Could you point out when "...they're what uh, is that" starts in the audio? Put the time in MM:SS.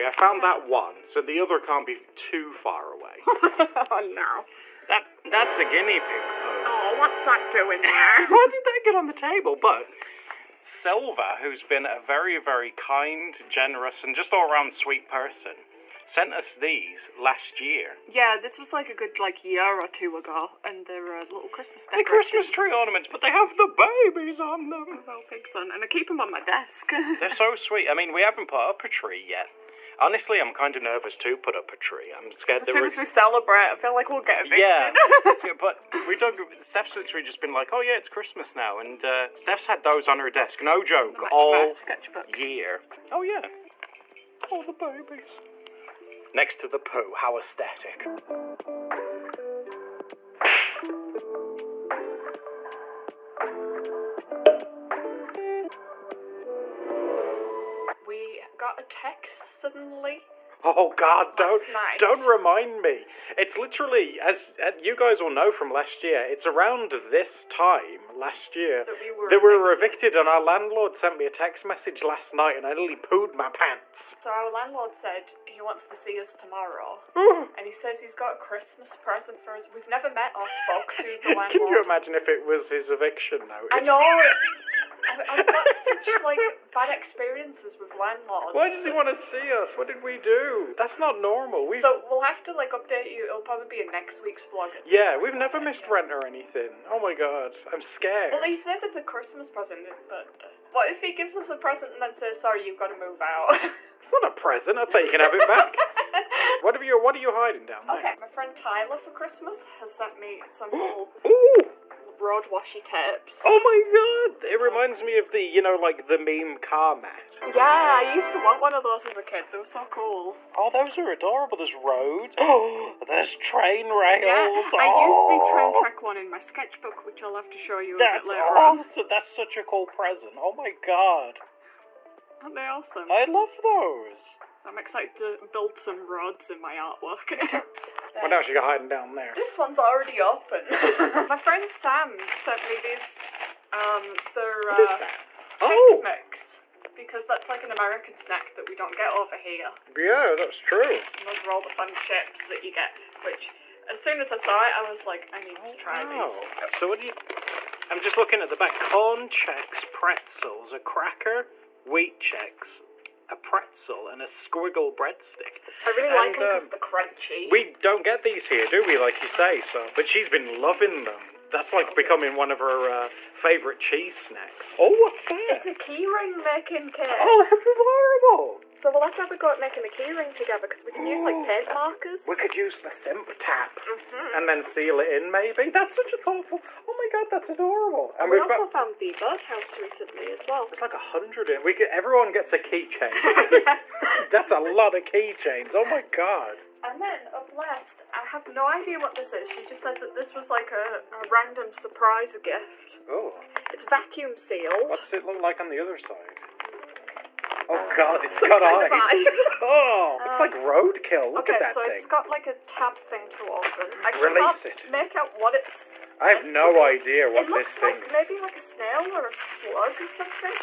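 02:24.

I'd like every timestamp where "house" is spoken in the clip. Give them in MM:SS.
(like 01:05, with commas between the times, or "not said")
03:09.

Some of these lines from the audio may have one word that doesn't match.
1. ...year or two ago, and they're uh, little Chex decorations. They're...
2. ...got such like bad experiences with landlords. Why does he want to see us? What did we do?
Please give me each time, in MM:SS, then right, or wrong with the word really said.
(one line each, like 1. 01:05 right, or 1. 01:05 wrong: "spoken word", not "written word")
1. 00:19 wrong: "Christmas", not "Chex"
2. 01:25 right.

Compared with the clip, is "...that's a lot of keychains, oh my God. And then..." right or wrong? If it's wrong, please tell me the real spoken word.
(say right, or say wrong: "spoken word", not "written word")
right.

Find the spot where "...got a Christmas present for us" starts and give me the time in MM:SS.
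01:18.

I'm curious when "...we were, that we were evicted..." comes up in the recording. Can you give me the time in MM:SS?
01:08.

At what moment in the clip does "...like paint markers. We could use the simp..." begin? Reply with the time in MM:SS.
03:01.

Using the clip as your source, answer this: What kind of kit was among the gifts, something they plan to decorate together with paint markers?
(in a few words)
Keyring making kit.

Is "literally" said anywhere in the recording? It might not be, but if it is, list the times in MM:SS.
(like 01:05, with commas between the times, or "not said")
00:36, 01:03.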